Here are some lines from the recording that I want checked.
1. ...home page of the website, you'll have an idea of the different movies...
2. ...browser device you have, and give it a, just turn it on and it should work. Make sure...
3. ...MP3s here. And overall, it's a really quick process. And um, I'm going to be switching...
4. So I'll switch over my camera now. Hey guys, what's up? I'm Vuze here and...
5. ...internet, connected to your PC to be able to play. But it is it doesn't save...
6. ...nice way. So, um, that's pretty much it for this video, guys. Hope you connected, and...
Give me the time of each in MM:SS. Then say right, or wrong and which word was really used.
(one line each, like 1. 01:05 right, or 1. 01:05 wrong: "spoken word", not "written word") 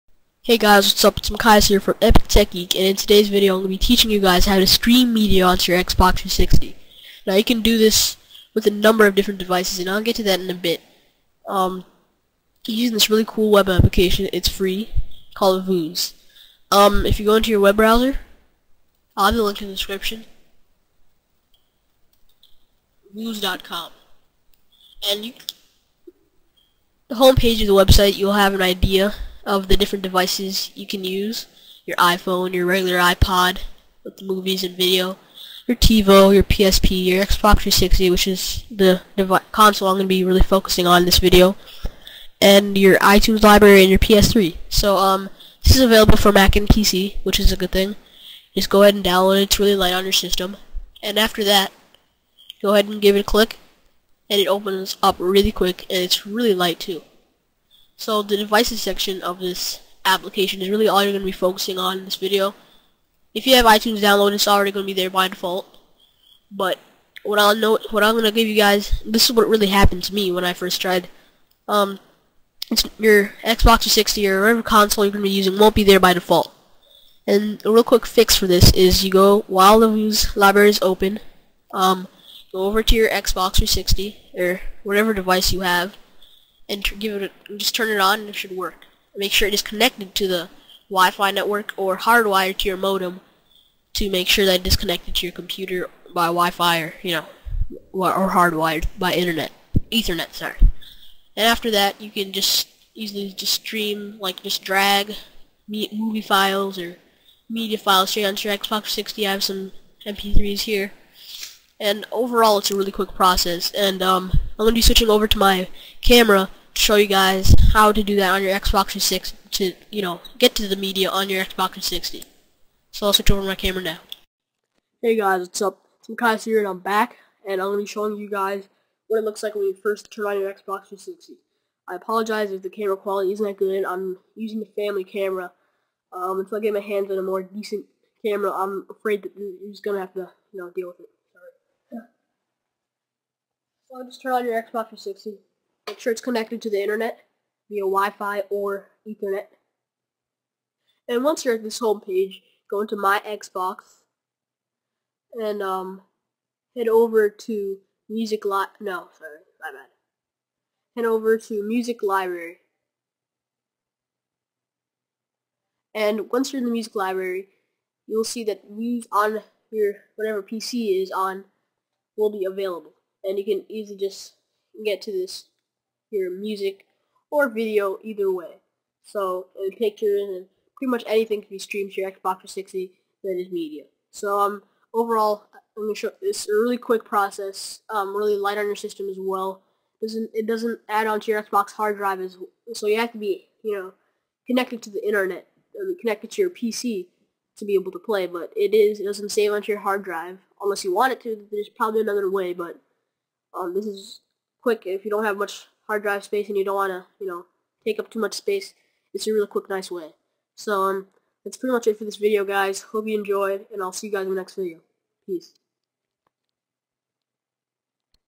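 1. 00:27 wrong: "devices", not "movies"
2. 01:24 wrong: "whatever", not "browser"
3. 01:50 right
4. 02:02 wrong: "Kai", not "Vuze"
5. 03:15 right
6. 03:29 wrong: "enjoyed", not "connected".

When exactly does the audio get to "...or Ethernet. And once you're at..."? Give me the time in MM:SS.
02:28.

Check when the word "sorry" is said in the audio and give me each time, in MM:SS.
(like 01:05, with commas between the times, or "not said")
01:40, 02:21, 02:39.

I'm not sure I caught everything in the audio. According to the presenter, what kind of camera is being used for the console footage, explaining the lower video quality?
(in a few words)
The family camera.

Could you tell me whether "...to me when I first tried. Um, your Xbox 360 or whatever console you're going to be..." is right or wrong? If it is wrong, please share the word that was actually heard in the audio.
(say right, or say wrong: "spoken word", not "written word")
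right.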